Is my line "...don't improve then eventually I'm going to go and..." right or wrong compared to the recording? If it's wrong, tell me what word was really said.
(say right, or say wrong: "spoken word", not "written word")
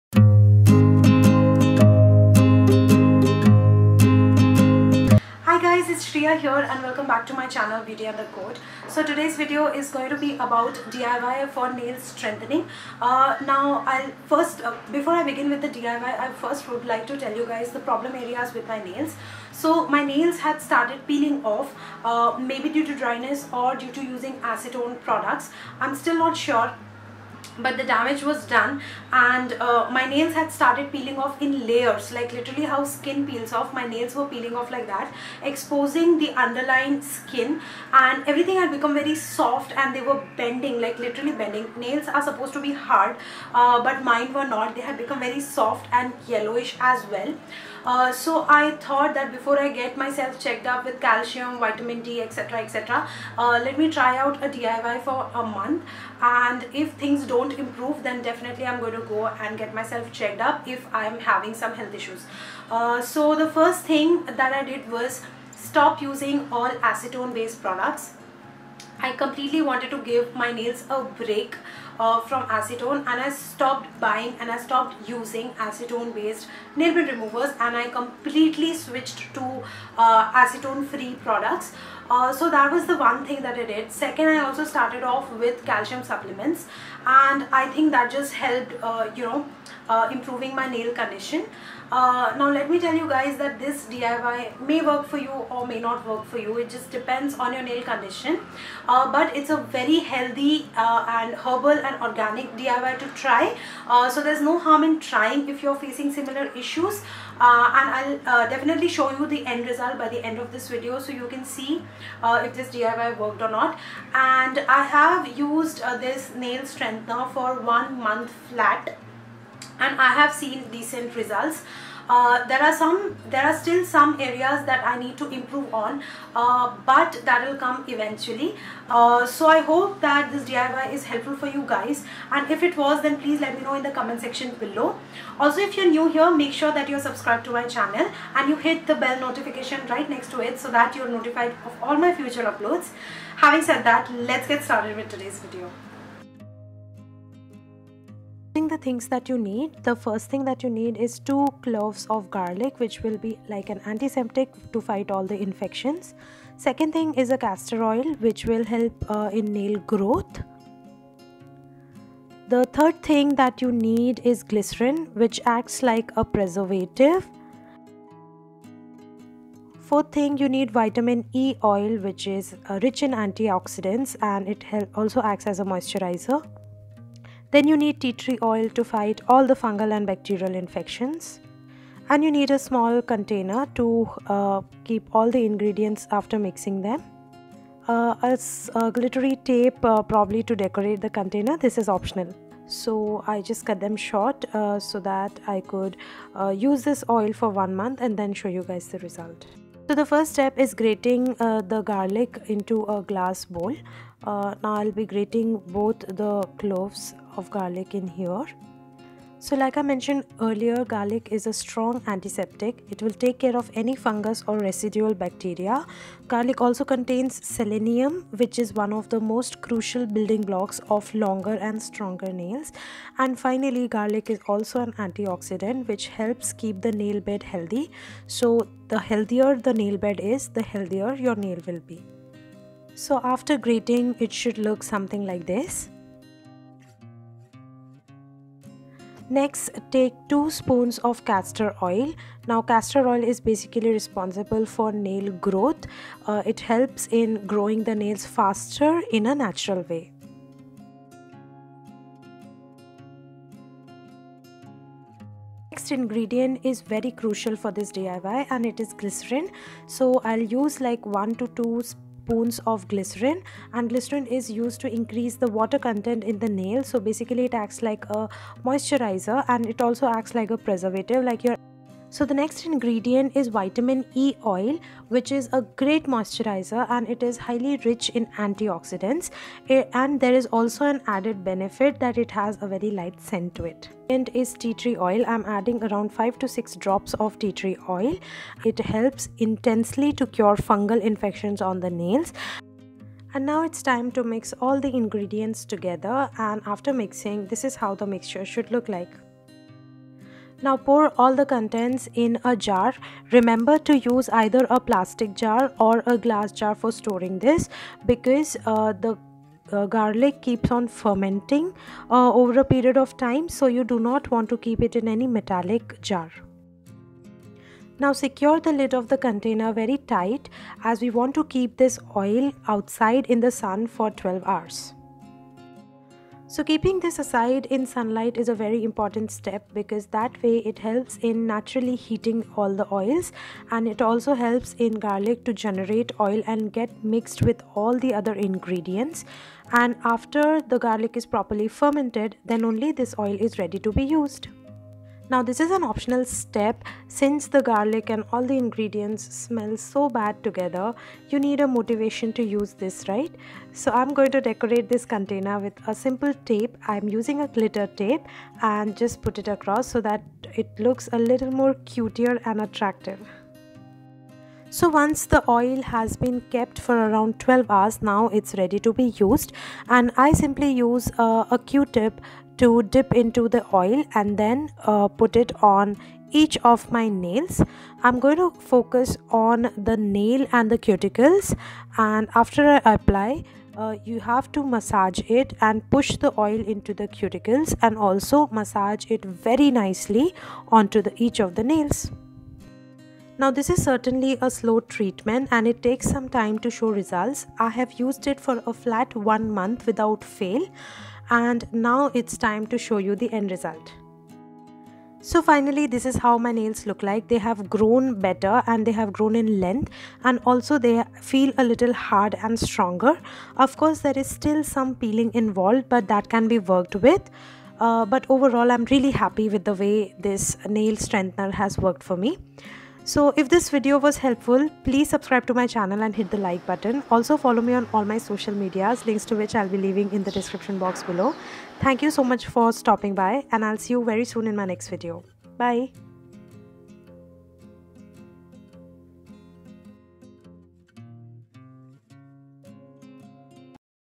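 wrong: "definitely", not "eventually".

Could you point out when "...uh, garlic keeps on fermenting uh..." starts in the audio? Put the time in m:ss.
5:09.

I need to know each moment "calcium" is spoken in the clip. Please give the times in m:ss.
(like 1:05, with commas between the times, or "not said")
0:51, 1:25.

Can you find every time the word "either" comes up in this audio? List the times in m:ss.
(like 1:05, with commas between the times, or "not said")
5:04.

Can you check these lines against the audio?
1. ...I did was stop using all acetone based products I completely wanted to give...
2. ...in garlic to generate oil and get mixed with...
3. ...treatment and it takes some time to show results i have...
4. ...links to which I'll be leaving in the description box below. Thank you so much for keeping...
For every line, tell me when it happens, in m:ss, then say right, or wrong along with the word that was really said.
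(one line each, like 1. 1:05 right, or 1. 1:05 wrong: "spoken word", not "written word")
1. 1:04 right
2. 5:34 right
3. 6:34 right
4. 7:09 wrong: "stopping", not "keeping".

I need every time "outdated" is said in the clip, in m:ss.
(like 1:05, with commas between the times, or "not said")
not said.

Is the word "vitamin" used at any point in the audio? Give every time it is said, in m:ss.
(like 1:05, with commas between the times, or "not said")
0:51, 2:50, 4:33.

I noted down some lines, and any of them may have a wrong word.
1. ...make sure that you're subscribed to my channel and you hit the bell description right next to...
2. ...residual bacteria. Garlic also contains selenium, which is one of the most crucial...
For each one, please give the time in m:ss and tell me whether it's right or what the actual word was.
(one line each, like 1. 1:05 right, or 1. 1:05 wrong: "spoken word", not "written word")
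1. 2:16 wrong: "notification", not "description"
2. 3:34 right.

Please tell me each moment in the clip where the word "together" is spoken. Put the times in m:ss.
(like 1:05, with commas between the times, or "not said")
4:55, 5:50.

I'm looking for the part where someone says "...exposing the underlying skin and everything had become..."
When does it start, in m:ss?
0:35.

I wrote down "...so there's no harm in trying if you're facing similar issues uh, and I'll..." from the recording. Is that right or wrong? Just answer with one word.
right.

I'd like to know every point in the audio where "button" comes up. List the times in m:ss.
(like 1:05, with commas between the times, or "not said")
7:06.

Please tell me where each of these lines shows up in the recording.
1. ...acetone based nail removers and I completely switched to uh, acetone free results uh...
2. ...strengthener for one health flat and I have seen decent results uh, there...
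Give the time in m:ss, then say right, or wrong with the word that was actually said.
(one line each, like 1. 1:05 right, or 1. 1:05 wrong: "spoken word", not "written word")
1. 1:15 wrong: "products", not "results"
2. 1:56 wrong: "month", not "health".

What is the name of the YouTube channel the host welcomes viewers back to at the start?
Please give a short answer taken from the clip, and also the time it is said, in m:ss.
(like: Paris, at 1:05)
Beauty and the Code, at 0:07.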